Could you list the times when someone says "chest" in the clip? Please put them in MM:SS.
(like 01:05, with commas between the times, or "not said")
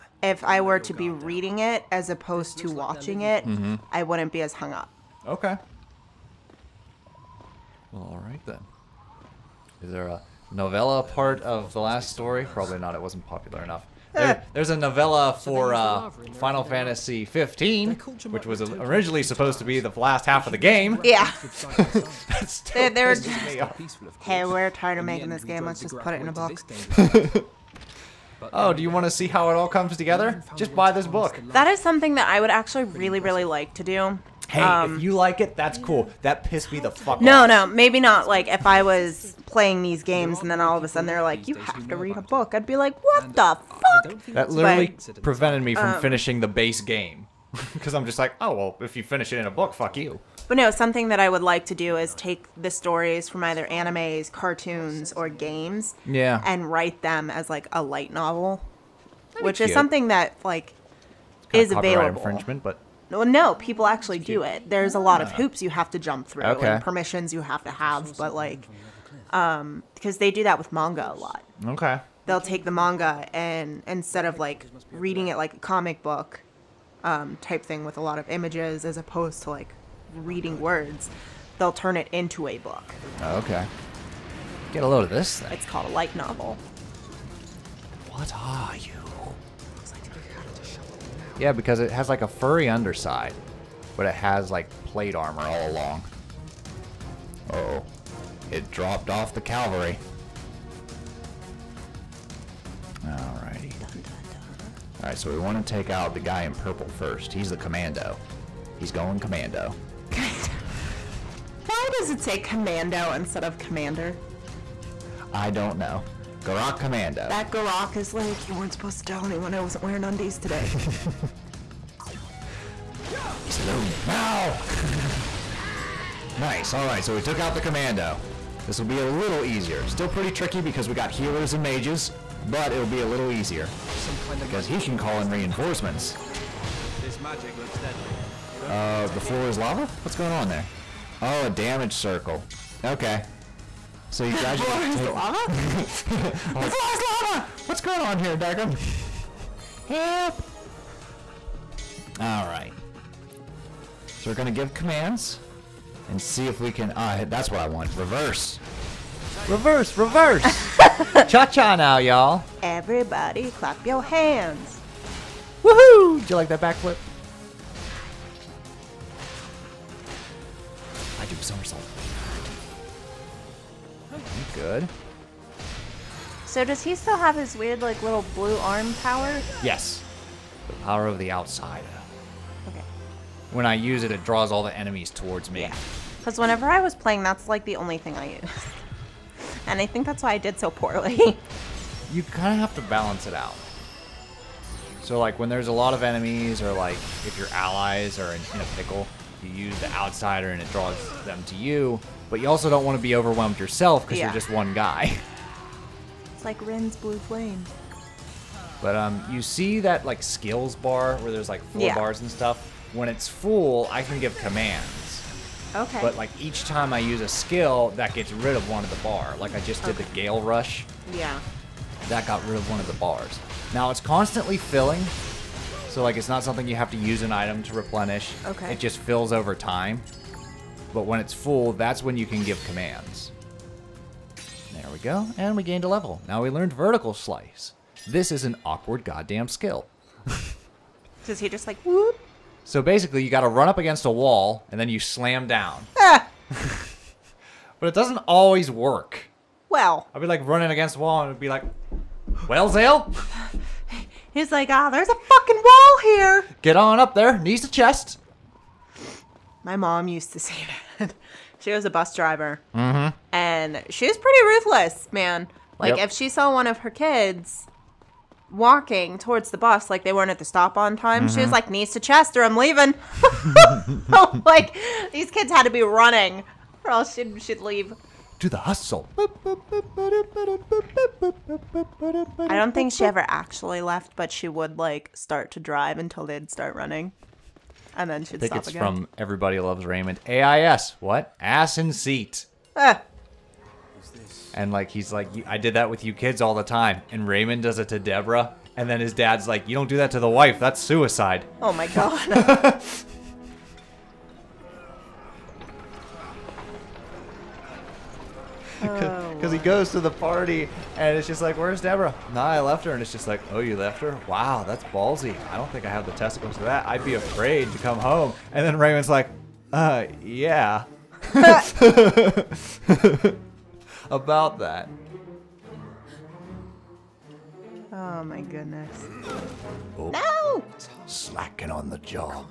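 04:17, 04:32.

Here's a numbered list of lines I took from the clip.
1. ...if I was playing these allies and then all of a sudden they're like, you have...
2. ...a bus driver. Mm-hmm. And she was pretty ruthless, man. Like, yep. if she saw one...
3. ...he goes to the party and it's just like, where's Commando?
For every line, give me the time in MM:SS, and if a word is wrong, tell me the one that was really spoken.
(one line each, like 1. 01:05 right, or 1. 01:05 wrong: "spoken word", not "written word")
1. 00:38 wrong: "games", not "allies"
2. 04:21 right
3. 05:09 wrong: "Deborah", not "Commando".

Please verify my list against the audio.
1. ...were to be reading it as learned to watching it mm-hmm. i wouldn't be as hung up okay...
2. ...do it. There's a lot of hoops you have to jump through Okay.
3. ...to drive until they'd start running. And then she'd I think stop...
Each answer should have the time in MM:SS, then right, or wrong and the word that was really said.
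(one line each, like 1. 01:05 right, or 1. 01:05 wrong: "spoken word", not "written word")
1. 00:00 wrong: "opposed", not "learned"
2. 01:04 right
3. 04:45 right.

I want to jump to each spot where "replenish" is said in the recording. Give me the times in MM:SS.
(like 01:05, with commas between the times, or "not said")
03:47.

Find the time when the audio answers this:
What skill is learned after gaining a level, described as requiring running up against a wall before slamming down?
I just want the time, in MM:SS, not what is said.
03:56.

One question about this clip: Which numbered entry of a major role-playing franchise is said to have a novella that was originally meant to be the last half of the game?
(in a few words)
Final Fantasy 15.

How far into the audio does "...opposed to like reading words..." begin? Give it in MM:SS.
01:18.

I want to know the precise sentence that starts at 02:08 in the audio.
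This will be a little easier.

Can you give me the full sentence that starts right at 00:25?
Let's just put it in a book.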